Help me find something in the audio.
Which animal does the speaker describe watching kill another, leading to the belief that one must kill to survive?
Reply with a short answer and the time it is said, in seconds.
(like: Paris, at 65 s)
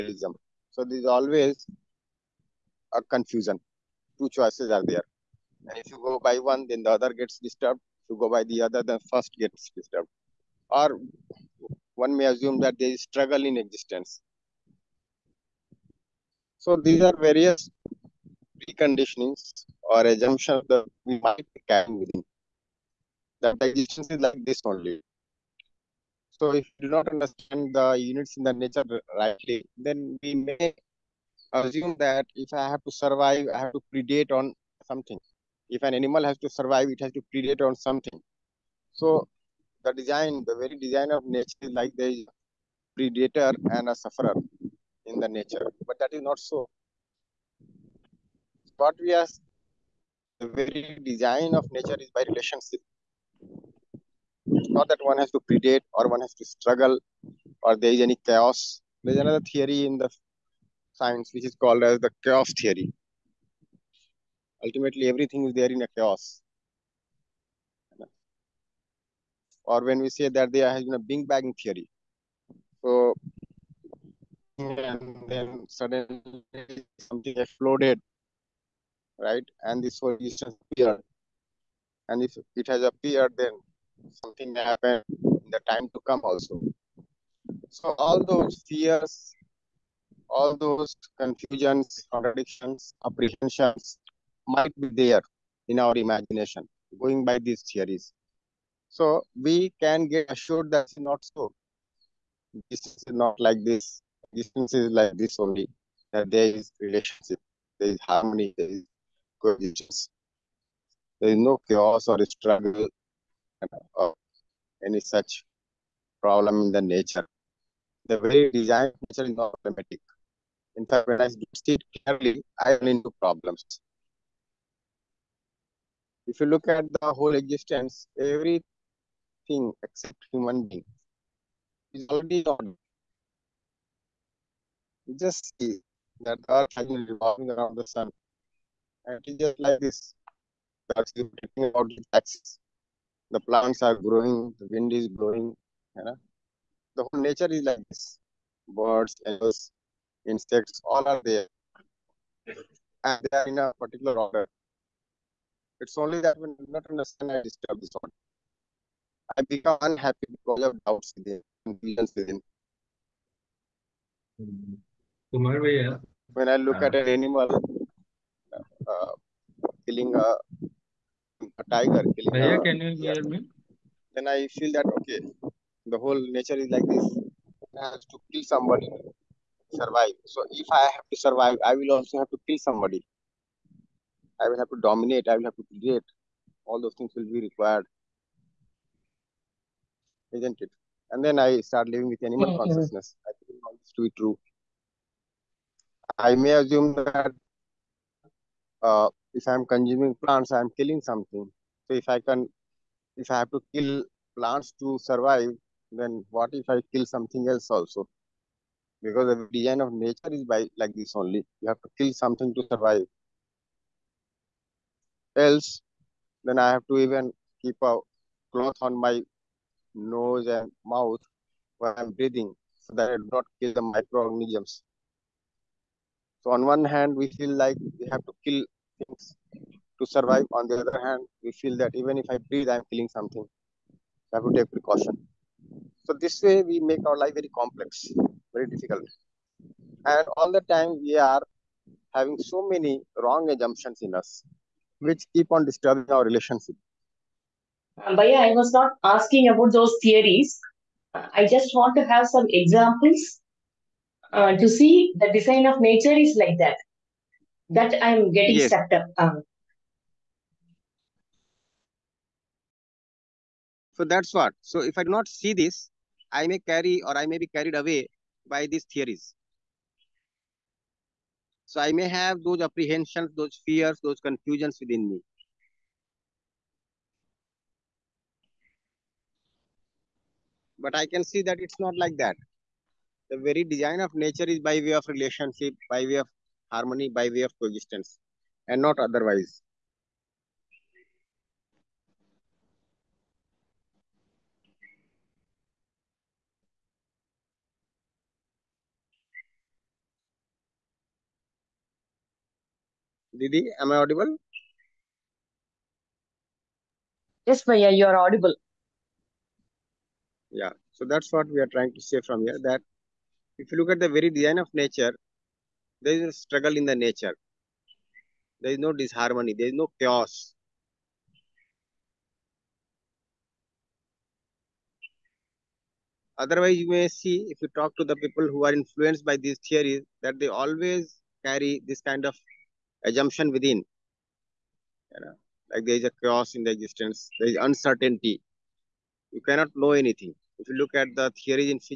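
A tiger, at 171 s.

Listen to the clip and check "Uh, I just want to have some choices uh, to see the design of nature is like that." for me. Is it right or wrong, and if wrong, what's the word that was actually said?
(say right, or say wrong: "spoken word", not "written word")
wrong: "examples", not "choices".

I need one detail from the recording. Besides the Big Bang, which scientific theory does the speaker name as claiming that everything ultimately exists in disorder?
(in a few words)
Chaos theory.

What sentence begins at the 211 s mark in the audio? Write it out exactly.
You have to kill something to survive.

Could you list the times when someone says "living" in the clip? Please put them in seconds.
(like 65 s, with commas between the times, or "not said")
191 s.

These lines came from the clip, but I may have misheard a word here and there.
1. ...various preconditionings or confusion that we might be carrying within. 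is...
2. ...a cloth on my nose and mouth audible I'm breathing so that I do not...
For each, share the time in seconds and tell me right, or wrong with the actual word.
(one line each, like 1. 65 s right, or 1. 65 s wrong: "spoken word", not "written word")
1. 17 s wrong: "assumption", not "confusion"
2. 217 s wrong: "while", not "audible".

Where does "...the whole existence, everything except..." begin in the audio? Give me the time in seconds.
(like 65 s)
127 s.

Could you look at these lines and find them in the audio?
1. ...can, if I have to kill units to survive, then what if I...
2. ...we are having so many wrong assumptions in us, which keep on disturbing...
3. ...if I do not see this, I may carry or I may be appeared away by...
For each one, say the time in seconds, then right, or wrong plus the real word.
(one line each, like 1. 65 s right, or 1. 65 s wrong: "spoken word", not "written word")
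1. 202 s wrong: "plants", not "units"
2. 241 s right
3. 264 s wrong: "carried", not "appeared".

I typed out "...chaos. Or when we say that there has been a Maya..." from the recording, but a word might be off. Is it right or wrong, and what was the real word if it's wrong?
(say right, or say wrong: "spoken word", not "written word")
wrong: "Big", not "Maya".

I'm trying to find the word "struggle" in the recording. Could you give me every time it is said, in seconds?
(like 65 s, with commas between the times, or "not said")
13 s, 56 s, 112 s, 316 s.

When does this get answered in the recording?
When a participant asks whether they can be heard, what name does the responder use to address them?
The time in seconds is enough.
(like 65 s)
307 s.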